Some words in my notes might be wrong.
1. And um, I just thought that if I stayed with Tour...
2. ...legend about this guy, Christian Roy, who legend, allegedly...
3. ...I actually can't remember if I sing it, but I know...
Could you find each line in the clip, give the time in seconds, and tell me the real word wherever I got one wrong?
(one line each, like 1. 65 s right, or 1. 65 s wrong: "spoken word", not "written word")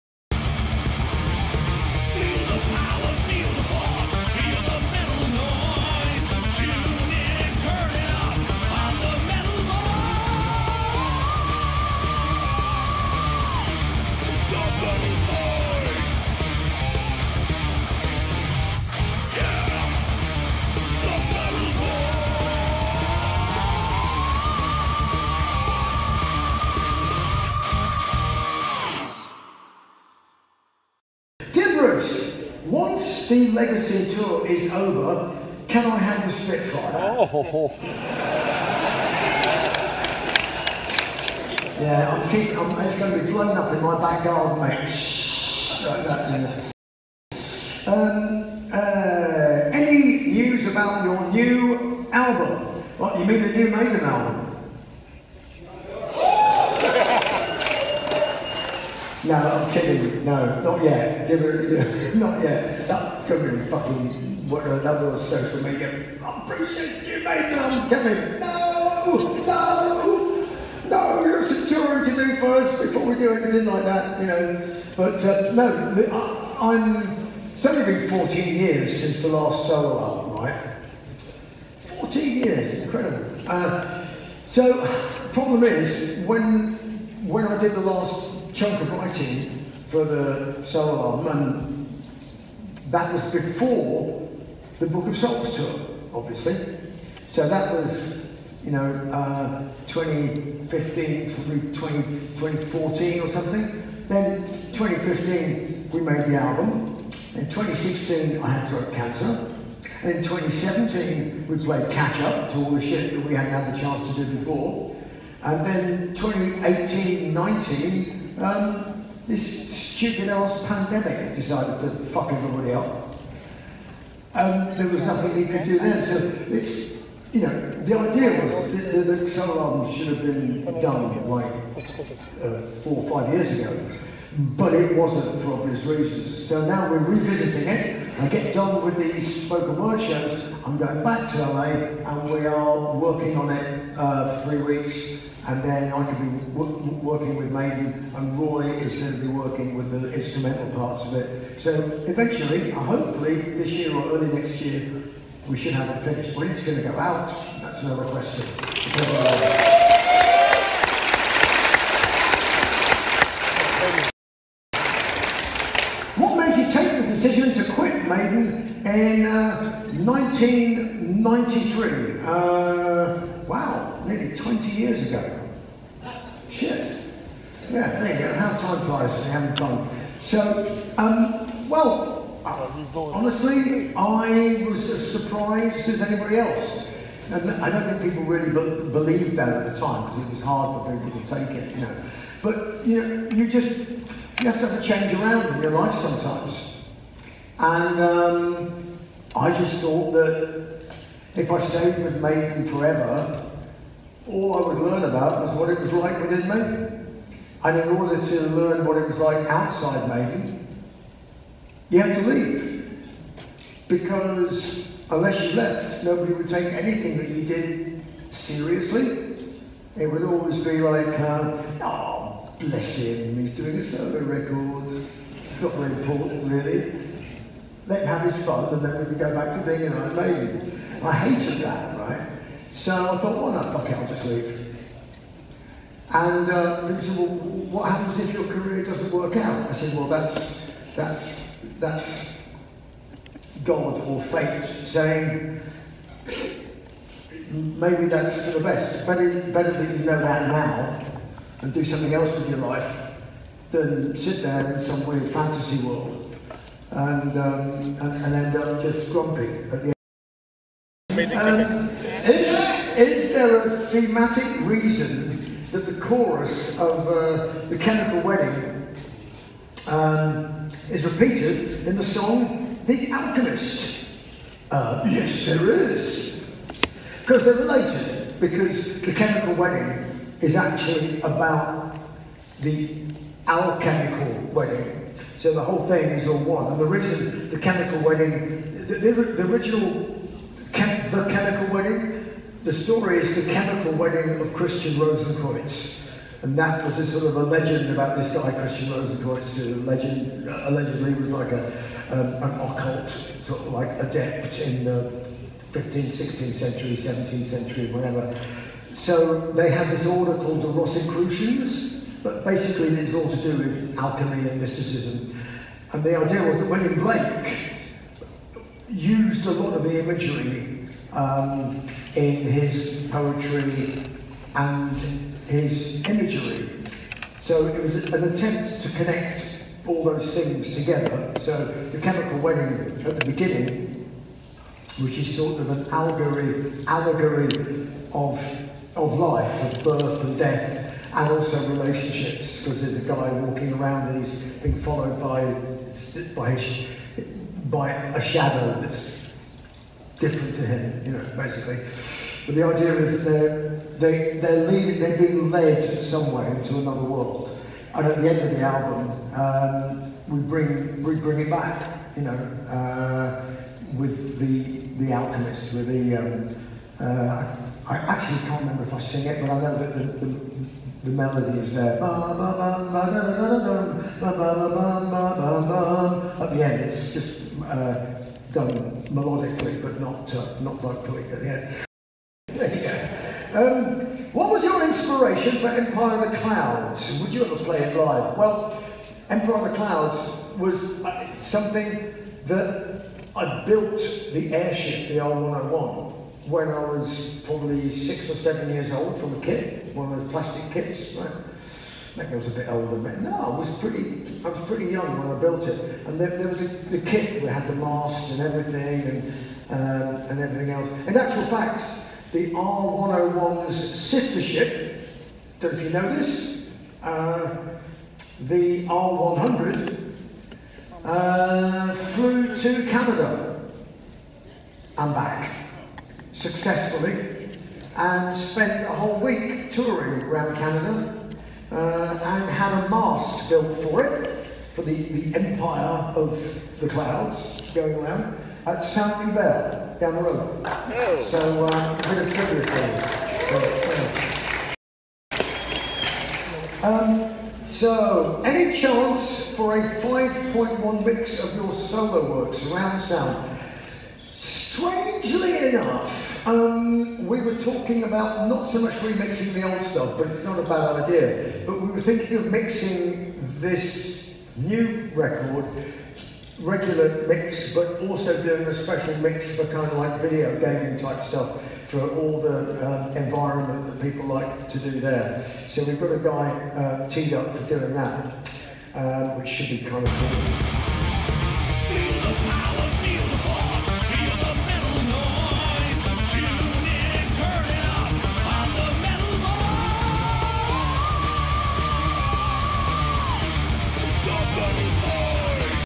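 1. 197 s wrong: "Maiden", not "Tour"
2. 297 s wrong: "Rosenkreutz", not "Roy"
3. 367 s right.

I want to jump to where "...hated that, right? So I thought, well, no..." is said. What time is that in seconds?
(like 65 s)
231 s.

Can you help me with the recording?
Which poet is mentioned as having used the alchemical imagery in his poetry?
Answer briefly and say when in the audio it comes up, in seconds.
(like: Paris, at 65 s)
William Blake, at 316 s.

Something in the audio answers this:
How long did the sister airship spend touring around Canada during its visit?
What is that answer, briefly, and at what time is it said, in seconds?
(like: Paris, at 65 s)
a whole week, at 428 s.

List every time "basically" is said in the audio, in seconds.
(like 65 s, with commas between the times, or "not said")
312 s, 351 s.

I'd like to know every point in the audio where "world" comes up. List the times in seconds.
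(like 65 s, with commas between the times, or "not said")
255 s, 357 s.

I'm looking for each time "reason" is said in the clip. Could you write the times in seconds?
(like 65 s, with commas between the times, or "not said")
135 s, 264 s, 286 s.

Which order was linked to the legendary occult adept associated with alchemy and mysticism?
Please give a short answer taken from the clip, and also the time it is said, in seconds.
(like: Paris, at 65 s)
Rosicrucians, at 310 s.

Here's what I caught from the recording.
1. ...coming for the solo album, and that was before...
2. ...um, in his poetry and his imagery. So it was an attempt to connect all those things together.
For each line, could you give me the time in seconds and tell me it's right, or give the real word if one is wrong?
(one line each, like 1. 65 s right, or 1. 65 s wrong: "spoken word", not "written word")
1. 88 s wrong: "writing", not "coming"
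2. 321 s right.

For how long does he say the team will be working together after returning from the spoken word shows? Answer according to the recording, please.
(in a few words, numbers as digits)
three weeks.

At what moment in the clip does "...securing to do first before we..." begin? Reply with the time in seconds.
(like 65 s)
71 s.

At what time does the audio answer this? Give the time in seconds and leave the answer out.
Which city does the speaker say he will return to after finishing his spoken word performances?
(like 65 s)
141 s.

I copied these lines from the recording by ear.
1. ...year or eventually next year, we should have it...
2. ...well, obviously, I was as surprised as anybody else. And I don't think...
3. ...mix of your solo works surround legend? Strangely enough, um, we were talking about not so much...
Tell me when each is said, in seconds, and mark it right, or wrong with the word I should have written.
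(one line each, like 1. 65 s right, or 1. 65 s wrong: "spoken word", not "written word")
1. 153 s wrong: "early", not "eventually"
2. 181 s wrong: "honestly", not "obviously"
3. 451 s wrong: "sound", not "legend".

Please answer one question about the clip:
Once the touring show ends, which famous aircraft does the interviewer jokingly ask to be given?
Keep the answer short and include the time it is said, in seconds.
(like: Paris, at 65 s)
Spitfire, at 36 s.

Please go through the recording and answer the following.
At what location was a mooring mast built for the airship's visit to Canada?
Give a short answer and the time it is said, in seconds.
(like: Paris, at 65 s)
St. Hubert, at 438 s.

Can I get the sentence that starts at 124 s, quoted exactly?
And um, there was nothing he could do then.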